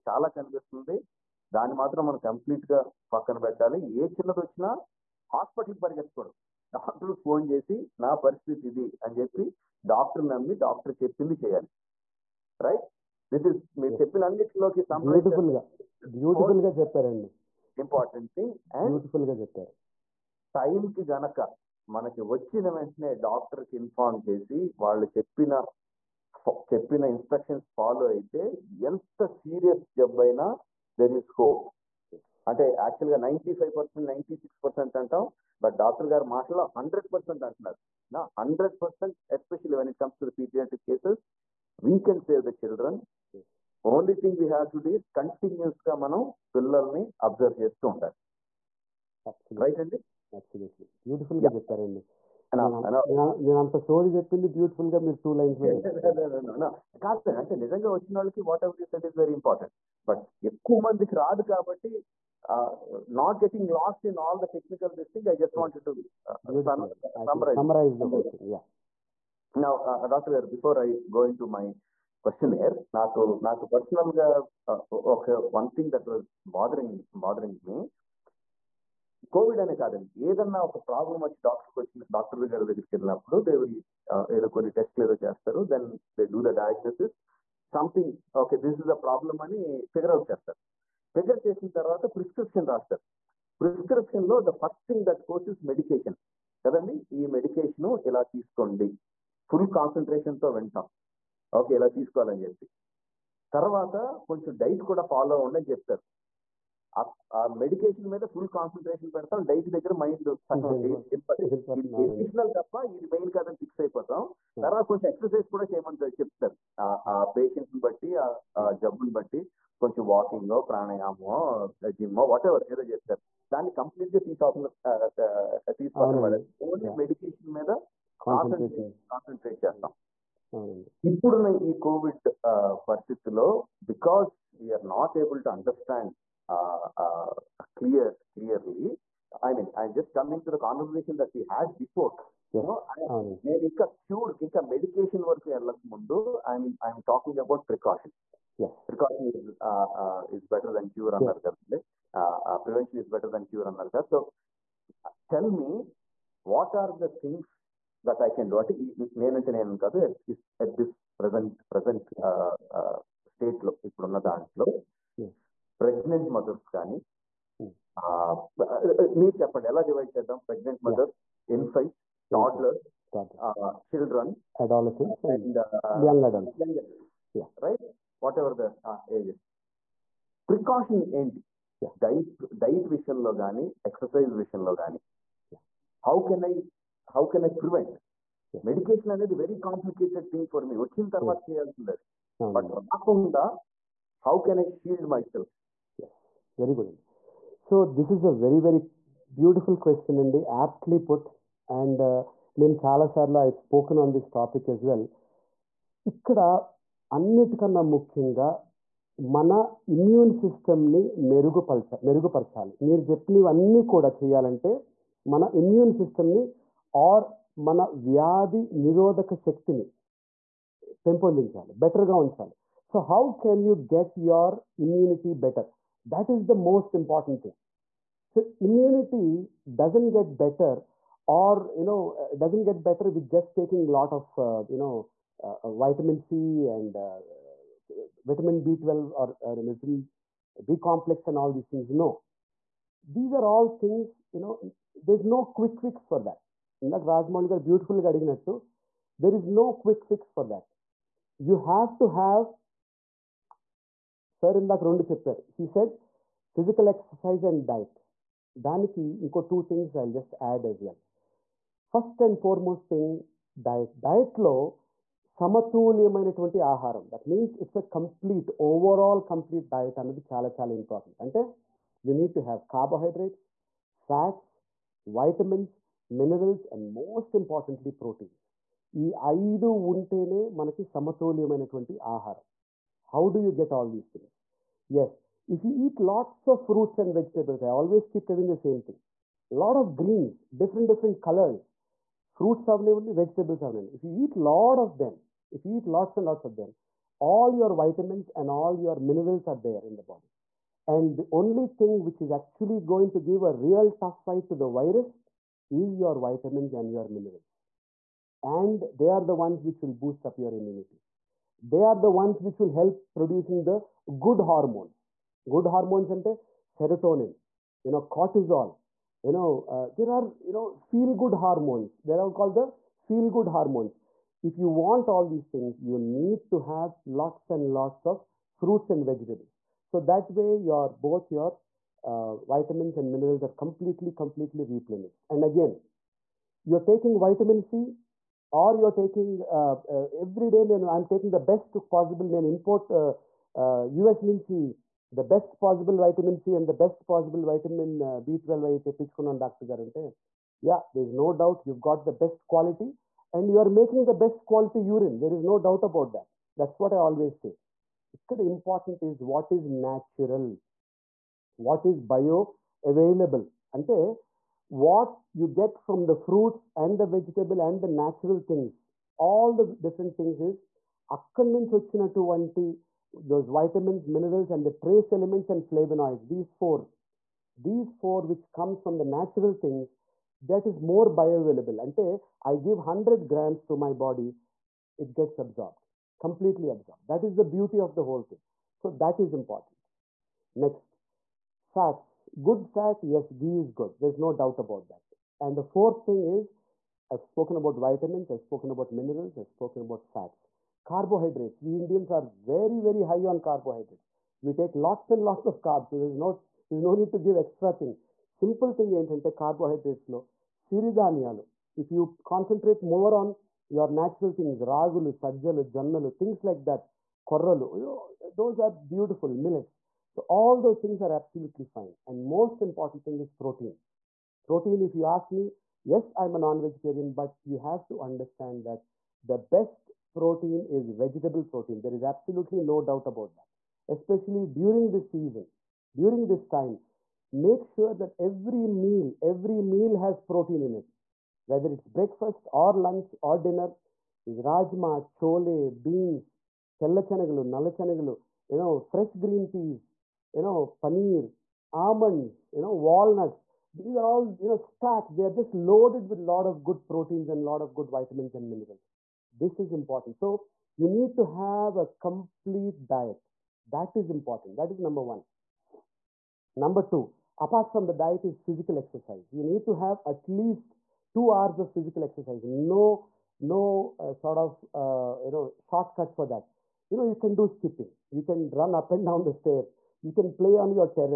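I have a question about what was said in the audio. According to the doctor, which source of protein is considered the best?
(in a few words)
Vegetable protein.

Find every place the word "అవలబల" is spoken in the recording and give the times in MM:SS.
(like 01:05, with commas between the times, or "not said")
06:02, 06:21.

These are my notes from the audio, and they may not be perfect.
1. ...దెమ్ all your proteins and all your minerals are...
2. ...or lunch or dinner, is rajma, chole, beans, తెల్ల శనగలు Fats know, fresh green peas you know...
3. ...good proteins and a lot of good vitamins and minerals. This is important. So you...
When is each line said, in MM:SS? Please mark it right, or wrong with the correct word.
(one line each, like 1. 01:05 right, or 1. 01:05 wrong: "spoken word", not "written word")
1. 04:56 wrong: "vitamins", not "proteins"
2. 07:22 wrong: "You", not "Fats"
3. 07:36 right.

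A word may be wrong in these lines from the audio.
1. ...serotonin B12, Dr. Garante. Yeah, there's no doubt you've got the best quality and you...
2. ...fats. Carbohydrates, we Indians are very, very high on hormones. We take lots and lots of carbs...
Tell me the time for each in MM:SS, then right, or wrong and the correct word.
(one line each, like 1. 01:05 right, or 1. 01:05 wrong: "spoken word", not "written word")
1. 05:47 wrong: "vitamin", not "serotonin"
2. 06:40 wrong: "carbohydrates", not "hormones".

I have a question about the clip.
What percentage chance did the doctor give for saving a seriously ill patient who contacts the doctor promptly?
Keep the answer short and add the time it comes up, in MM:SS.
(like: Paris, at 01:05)
100 percent, at 00:38.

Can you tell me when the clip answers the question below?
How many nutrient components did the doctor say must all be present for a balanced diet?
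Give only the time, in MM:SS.
04:39.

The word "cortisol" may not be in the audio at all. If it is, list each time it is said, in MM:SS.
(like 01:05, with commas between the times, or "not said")
05:18.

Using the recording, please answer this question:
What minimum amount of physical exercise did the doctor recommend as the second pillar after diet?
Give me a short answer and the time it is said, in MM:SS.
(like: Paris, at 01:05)
2 hours, at 07:51.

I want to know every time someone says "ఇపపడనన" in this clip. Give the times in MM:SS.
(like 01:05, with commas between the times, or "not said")
02:11, 02:43.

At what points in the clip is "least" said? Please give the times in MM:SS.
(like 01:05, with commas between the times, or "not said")
07:50.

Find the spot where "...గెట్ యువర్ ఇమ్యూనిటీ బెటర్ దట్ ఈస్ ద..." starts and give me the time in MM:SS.
03:43.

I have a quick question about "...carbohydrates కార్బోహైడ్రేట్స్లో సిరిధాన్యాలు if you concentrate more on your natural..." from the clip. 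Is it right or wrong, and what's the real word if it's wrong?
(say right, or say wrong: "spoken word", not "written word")
right.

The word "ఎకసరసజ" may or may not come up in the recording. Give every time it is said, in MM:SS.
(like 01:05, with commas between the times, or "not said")
01:55, 03:03, 04:16.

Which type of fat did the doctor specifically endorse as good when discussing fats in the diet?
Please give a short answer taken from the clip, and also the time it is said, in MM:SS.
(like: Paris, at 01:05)
Ghee, at 06:33.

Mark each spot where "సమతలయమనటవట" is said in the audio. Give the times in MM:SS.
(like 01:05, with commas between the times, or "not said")
04:25, 04:40.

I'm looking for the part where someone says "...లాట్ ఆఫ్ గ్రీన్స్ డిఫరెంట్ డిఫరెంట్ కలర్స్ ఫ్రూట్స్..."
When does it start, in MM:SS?
04:49.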